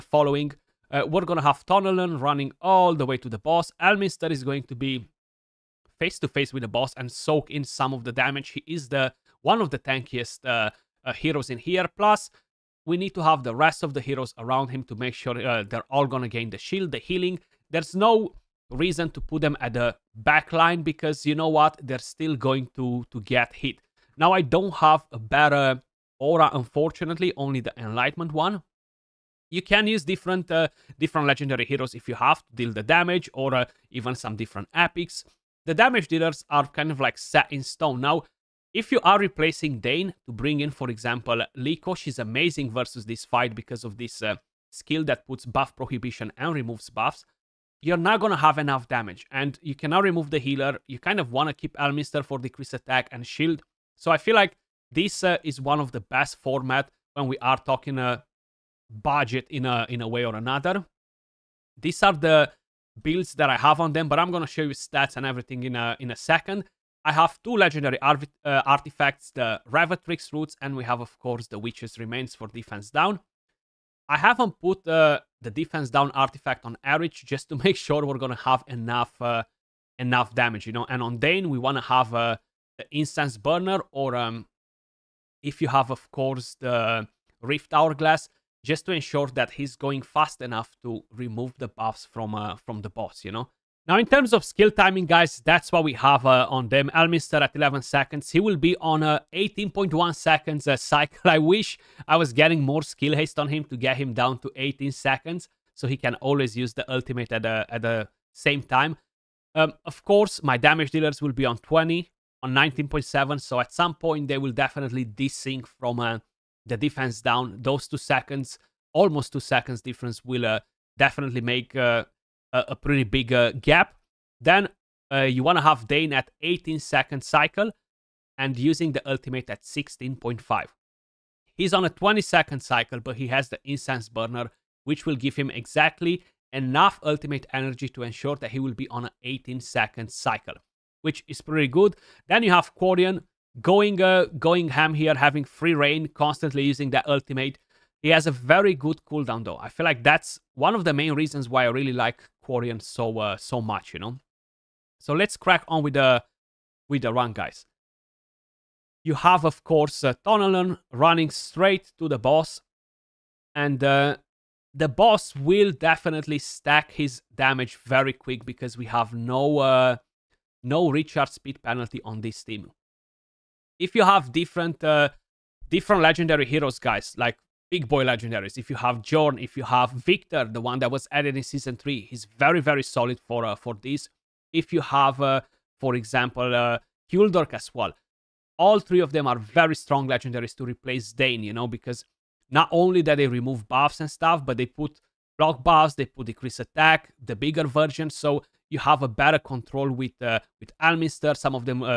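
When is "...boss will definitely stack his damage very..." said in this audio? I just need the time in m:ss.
2:44.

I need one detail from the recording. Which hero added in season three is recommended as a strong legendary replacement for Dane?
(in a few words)
Victor.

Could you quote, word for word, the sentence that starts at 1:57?
Those two seconds, almost two seconds difference will uh, definitely make uh, a, a pretty big uh, gap.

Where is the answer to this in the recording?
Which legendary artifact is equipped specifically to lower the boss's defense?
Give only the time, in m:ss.
1:11.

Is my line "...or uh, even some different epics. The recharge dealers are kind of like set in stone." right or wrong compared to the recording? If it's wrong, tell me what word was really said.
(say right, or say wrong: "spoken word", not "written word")
wrong: "damage", not "recharge".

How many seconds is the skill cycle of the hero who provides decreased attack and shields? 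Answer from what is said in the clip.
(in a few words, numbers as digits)
18.1 seconds.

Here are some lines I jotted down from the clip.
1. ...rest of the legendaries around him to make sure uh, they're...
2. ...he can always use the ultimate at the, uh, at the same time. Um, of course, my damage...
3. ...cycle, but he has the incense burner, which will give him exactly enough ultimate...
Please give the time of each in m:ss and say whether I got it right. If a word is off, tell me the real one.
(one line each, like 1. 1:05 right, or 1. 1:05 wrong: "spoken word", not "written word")
1. 0:13 wrong: "heroes", not "legendaries"
2. 1:45 right
3. 2:12 right.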